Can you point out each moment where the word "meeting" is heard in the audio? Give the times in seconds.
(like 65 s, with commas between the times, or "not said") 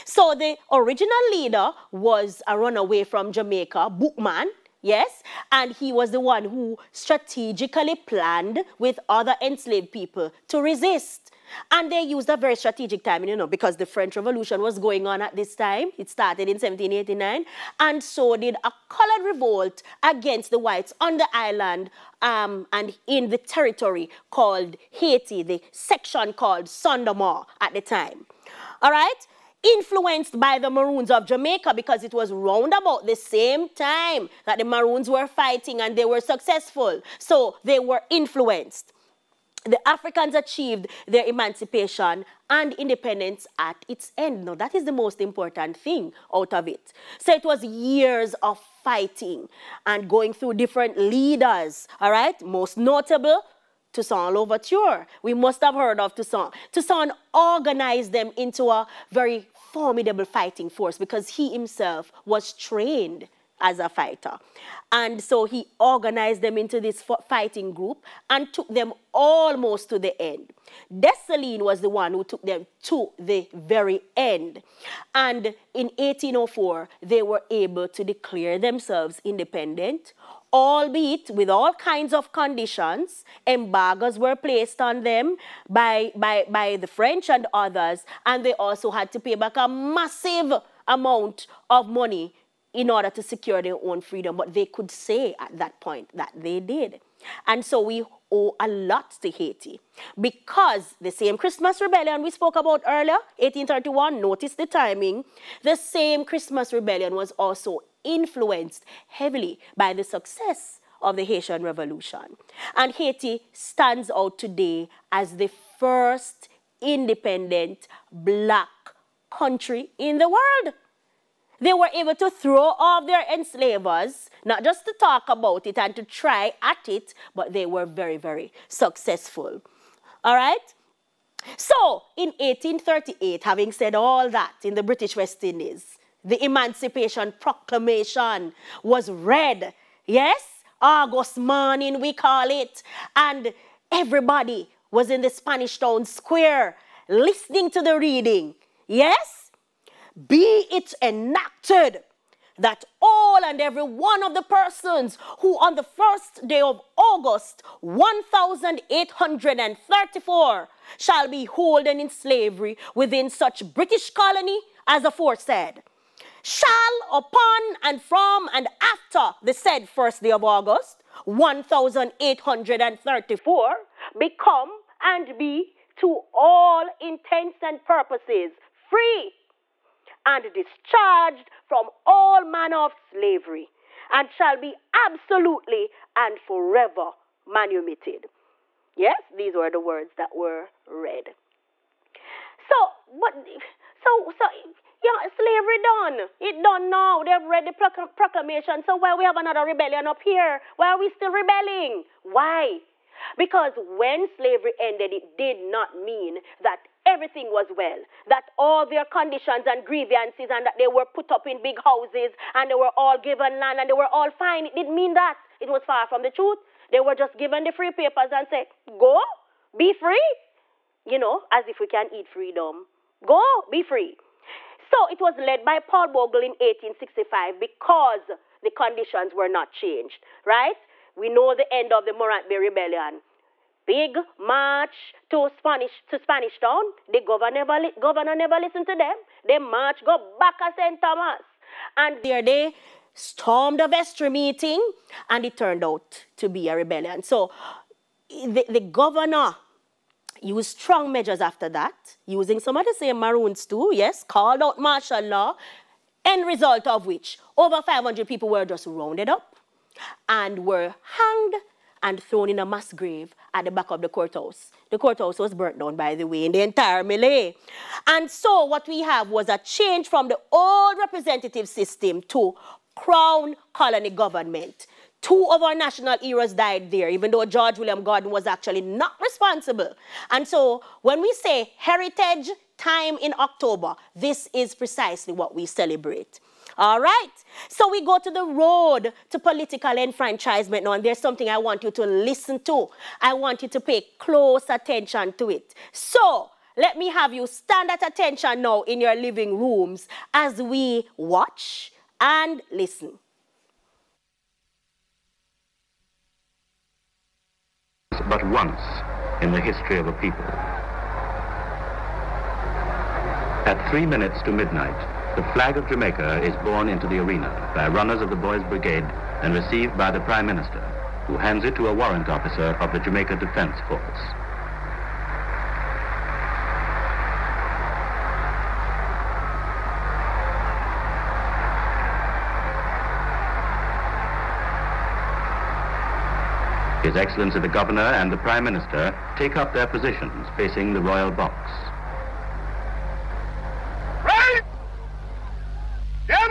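244 s.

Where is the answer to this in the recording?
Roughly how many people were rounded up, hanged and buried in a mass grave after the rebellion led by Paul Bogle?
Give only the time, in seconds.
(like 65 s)
257 s.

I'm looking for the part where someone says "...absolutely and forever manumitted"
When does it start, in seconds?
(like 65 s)
185 s.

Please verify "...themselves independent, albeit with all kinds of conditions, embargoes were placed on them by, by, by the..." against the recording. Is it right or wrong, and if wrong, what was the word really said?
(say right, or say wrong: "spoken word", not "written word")
right.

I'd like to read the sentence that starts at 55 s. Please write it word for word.
We must have heard of Toussaint.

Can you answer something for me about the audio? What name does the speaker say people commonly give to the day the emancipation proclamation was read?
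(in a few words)
August morning.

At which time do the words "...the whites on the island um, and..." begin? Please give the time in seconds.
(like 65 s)
20 s.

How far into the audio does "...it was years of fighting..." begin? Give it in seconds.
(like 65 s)
47 s.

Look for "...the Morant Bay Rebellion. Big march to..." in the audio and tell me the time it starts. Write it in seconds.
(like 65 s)
232 s.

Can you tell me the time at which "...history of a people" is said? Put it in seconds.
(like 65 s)
309 s.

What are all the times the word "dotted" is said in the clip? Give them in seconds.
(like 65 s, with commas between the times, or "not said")
not said.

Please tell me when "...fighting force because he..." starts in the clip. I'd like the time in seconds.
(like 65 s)
60 s.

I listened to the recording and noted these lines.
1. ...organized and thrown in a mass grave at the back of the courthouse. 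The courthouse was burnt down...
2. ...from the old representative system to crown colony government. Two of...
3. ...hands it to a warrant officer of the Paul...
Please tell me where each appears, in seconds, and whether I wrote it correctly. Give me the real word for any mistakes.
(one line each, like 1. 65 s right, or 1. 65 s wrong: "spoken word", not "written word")
1. 261 s wrong: "hanged", not "organized"
2. 270 s right
3. 321 s wrong: "Jamaica", not "Paul".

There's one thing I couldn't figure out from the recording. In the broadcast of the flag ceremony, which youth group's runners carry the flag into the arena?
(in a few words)
Boys Brigade.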